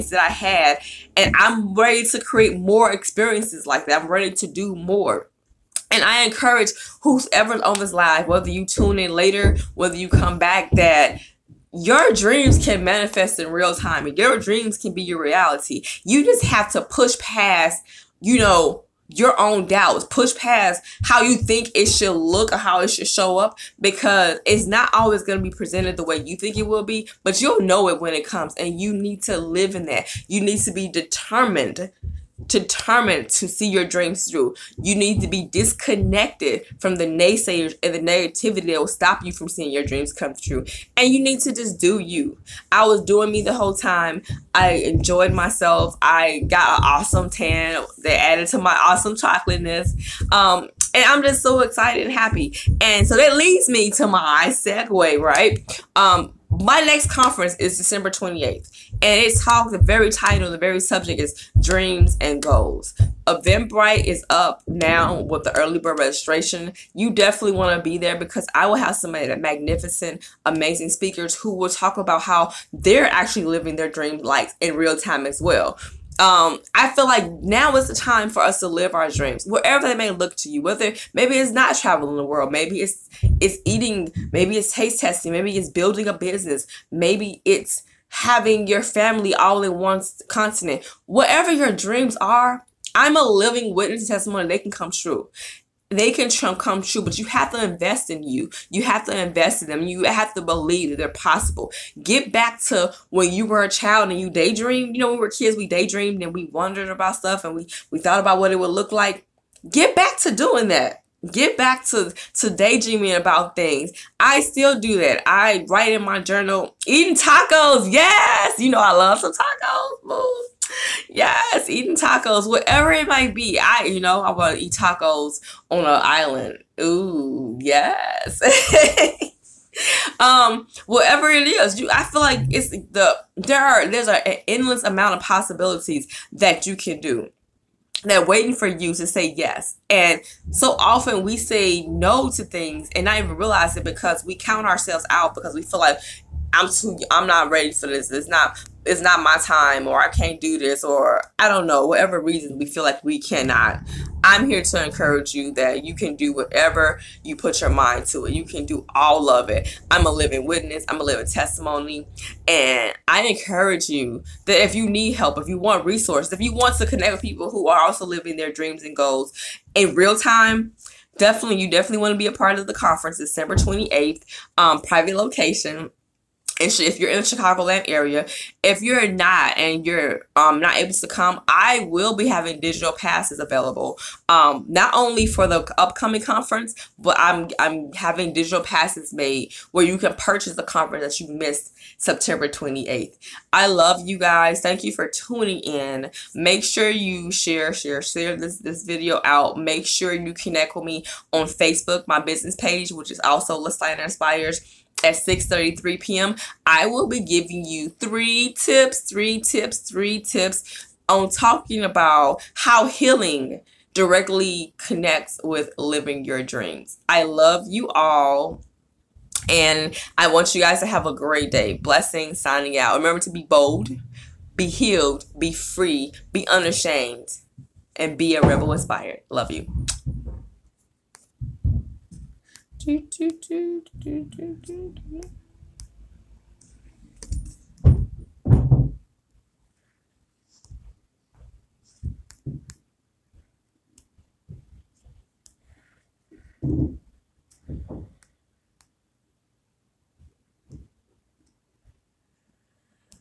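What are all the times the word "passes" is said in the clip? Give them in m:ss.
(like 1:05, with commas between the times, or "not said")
3:02, 3:08.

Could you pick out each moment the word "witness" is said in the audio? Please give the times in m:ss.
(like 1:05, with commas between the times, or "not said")
1:33, 2:40.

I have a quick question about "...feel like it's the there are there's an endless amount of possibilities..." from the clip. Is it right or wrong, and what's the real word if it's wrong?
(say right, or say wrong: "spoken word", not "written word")
right.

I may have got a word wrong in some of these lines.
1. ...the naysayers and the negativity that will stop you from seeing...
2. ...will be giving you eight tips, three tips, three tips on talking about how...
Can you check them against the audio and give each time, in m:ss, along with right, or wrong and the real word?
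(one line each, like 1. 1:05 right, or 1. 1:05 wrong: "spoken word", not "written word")
1. 0:36 right
2. 3:26 wrong: "three", not "eight".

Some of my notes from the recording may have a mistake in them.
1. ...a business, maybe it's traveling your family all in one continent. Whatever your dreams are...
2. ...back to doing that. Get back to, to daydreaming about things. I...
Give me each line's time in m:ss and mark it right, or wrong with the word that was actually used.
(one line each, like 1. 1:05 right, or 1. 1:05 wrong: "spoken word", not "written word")
1. 1:26 wrong: "having", not "traveling"
2. 1:49 right.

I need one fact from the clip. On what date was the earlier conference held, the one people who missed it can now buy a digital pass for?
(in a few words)
September 28.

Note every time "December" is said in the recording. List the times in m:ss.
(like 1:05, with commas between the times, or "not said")
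0:57, 2:53.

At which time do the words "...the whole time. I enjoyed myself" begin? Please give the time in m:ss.
0:43.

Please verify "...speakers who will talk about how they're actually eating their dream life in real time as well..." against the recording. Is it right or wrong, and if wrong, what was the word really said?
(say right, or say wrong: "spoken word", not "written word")
wrong: "living", not "eating".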